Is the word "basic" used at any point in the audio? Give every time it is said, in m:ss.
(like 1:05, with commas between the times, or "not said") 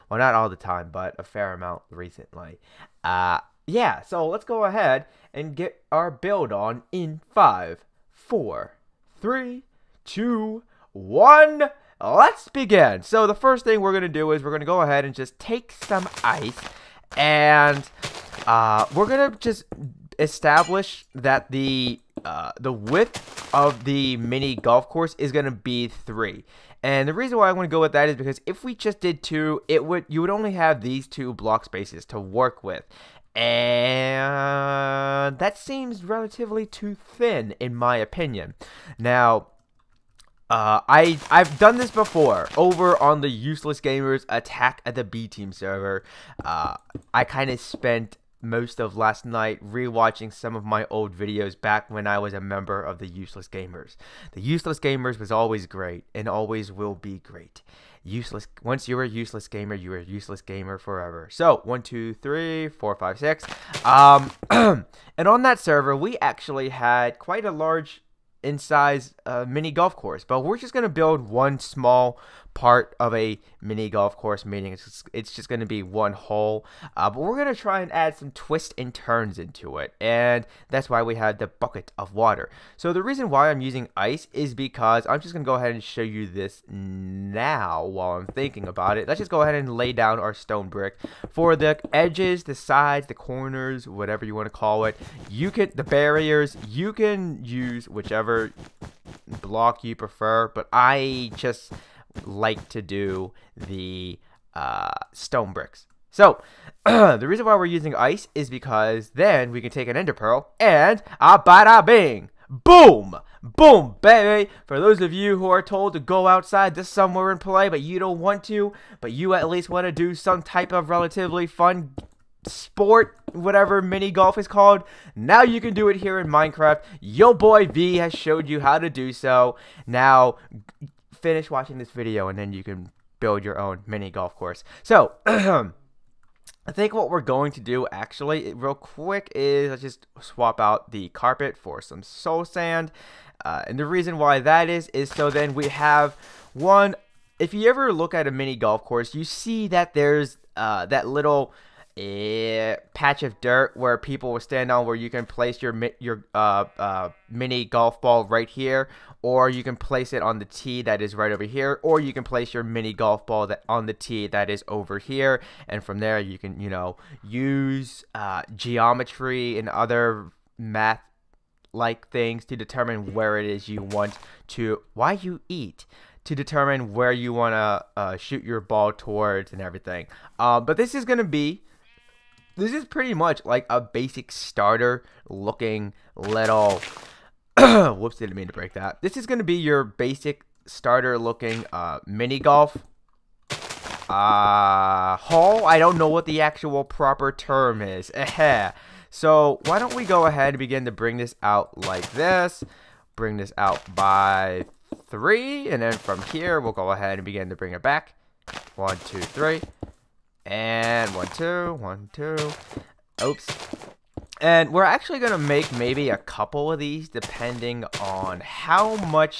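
3:03, 3:09.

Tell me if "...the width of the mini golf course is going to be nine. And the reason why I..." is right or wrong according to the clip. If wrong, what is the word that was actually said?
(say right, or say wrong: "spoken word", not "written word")
wrong: "three", not "nine".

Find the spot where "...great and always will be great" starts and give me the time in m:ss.
0:55.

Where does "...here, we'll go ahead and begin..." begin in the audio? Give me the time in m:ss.
3:26.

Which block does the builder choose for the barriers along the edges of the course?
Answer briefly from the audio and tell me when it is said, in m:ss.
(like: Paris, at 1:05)
stone bricks, at 1:45.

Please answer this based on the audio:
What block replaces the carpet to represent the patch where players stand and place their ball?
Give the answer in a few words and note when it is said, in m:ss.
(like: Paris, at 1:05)
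soul sand, at 2:22.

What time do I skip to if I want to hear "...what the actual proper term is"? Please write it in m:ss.
3:16.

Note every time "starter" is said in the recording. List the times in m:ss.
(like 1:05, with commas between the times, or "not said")
3:04, 3:10.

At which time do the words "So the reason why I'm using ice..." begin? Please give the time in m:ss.
1:22.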